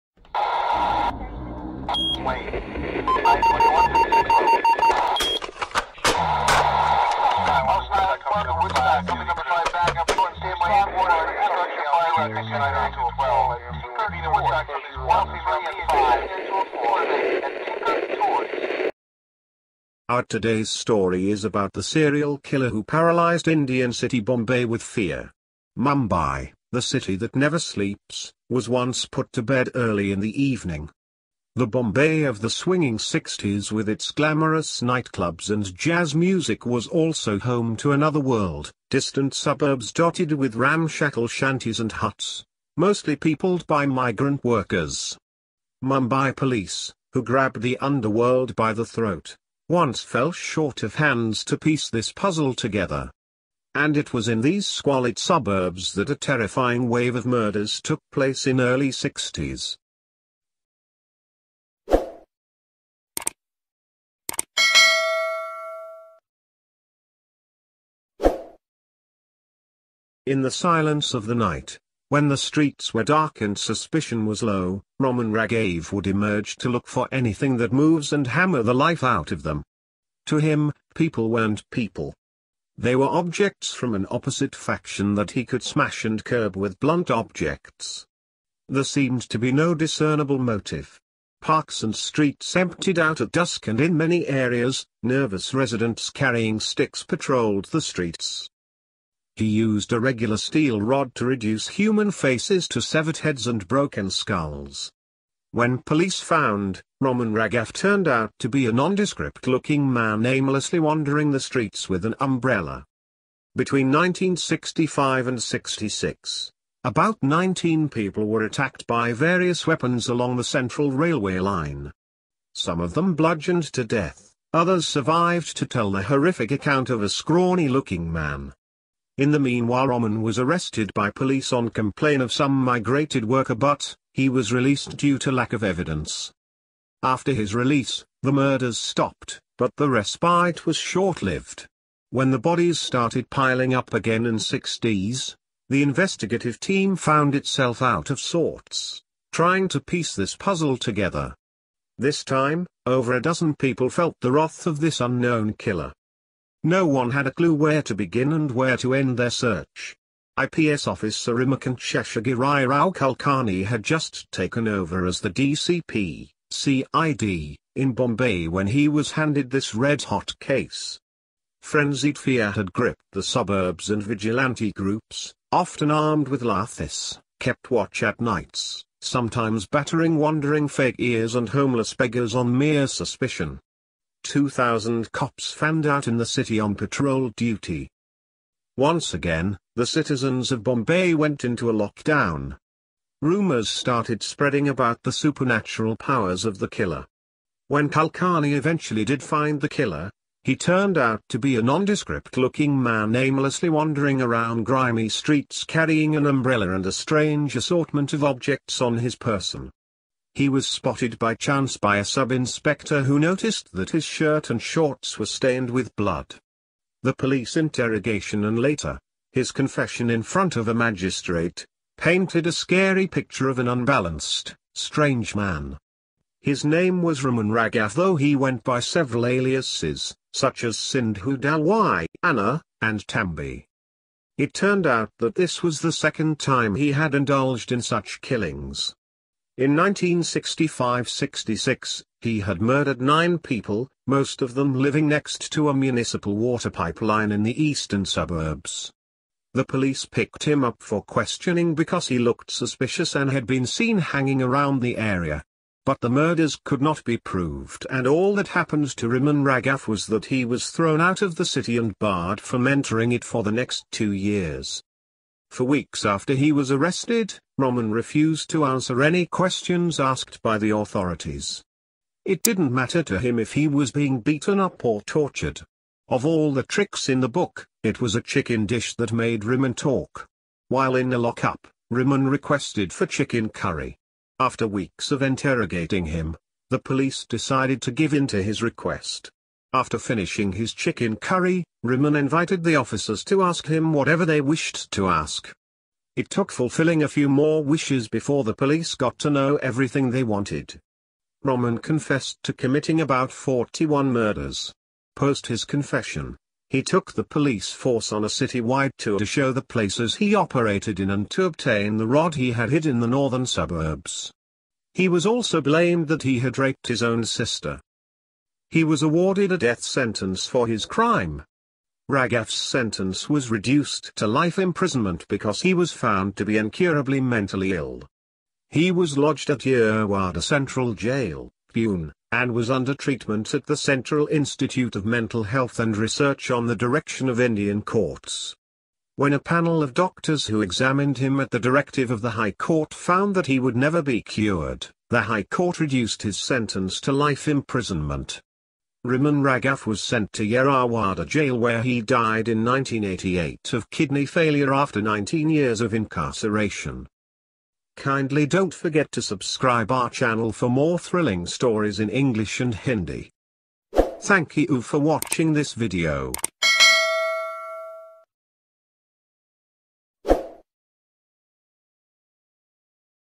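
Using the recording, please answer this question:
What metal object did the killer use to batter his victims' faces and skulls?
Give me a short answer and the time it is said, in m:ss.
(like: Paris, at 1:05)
steel rod, at 1:40.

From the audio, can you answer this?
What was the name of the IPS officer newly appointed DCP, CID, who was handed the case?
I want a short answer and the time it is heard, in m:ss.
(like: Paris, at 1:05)
Ramakant Sheshagiri Rao Kulkarni, at 2:41.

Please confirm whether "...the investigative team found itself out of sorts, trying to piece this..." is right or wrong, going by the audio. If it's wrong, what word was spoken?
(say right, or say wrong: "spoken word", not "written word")
right.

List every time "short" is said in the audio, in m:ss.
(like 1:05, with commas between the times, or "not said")
0:50, 2:20, 3:34.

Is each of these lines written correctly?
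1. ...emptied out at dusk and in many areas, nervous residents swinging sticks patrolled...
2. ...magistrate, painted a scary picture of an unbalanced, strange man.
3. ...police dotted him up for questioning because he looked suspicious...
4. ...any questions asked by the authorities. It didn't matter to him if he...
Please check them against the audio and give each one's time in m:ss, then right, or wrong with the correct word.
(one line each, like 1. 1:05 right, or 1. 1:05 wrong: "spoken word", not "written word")
1. 1:32 wrong: "carrying", not "swinging"
2. 3:40 right
3. 4:09 wrong: "picked", not "dotted"
4. 4:29 right.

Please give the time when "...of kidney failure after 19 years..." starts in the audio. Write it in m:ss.
5:53.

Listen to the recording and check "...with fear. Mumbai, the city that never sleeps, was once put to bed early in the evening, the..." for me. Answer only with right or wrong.
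right.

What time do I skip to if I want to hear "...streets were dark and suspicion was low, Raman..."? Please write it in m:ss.
1:12.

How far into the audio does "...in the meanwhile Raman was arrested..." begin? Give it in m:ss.
2:09.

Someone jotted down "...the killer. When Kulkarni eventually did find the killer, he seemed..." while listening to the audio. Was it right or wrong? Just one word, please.
wrong.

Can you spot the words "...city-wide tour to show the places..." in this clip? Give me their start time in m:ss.
5:08.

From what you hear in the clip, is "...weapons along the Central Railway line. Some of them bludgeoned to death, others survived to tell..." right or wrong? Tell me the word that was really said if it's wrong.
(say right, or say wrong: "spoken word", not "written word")
right.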